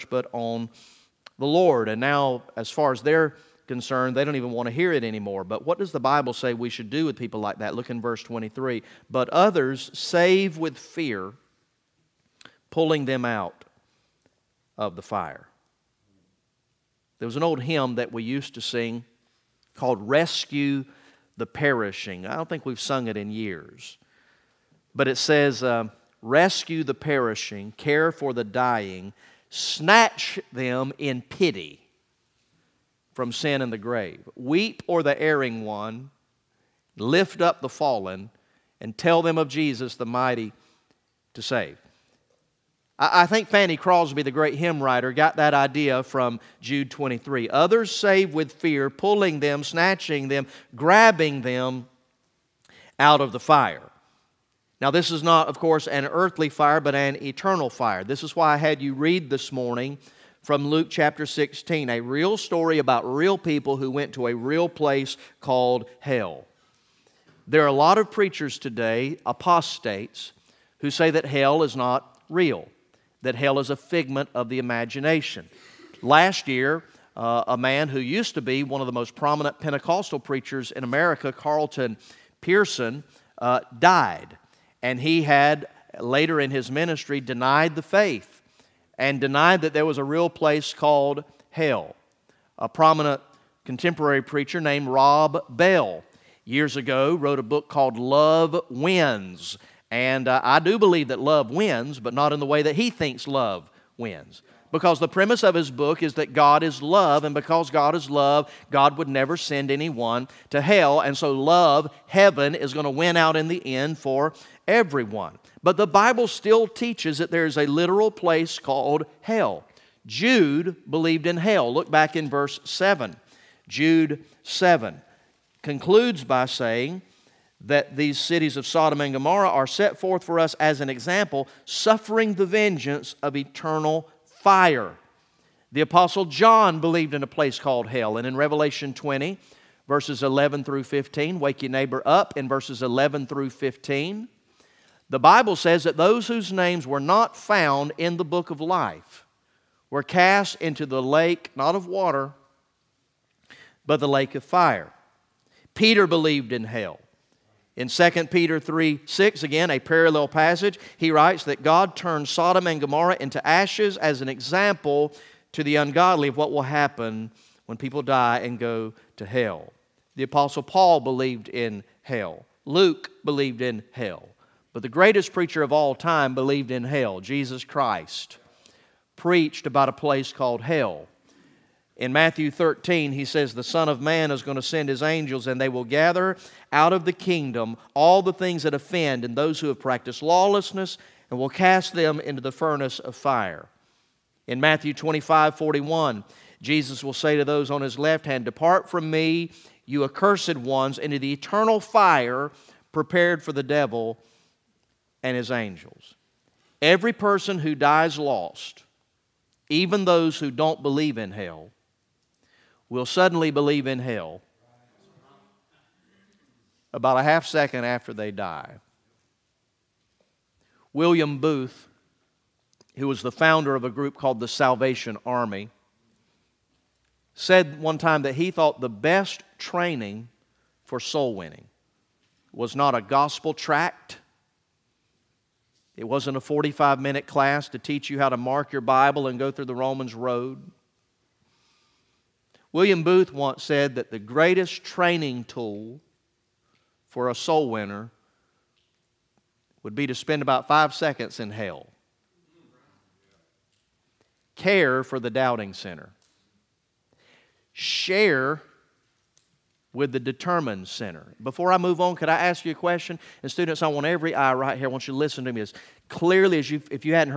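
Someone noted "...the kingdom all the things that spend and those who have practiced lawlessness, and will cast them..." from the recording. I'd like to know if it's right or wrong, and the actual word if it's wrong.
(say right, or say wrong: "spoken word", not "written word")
wrong: "offend", not "spend".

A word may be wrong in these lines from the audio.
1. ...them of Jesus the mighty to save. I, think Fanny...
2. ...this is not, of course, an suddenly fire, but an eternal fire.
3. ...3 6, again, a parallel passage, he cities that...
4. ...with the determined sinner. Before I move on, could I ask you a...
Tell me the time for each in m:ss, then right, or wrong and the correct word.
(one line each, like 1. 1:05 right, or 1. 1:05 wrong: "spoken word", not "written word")
1. 0:39 right
2. 0:54 wrong: "earthly", not "suddenly"
3. 2:38 wrong: "writes", not "cities"
4. 4:19 right.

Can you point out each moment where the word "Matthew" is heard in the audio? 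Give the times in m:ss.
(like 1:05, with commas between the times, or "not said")
3:02, 3:14.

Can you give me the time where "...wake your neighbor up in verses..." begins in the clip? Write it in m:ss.
2:21.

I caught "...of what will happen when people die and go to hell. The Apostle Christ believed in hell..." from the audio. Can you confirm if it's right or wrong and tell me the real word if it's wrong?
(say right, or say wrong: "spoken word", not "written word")
wrong: "Paul", not "Christ".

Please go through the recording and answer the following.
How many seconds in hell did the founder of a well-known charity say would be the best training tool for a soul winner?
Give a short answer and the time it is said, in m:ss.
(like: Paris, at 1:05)
5, at 4:10.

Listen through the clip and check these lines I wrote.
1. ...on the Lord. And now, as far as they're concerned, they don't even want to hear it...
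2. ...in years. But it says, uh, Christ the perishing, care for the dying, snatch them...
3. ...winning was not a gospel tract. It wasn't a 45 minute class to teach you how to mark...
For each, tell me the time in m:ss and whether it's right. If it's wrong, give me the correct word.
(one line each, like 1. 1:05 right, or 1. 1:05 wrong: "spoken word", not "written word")
1. 0:00 right
2. 0:23 wrong: "Rescue", not "Christ"
3. 3:51 right.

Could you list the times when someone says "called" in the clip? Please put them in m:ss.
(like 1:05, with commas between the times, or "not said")
0:19, 1:05, 1:30, 1:37, 1:58, 2:17, 3:00, 3:44.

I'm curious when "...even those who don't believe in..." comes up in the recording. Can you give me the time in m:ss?
3:29.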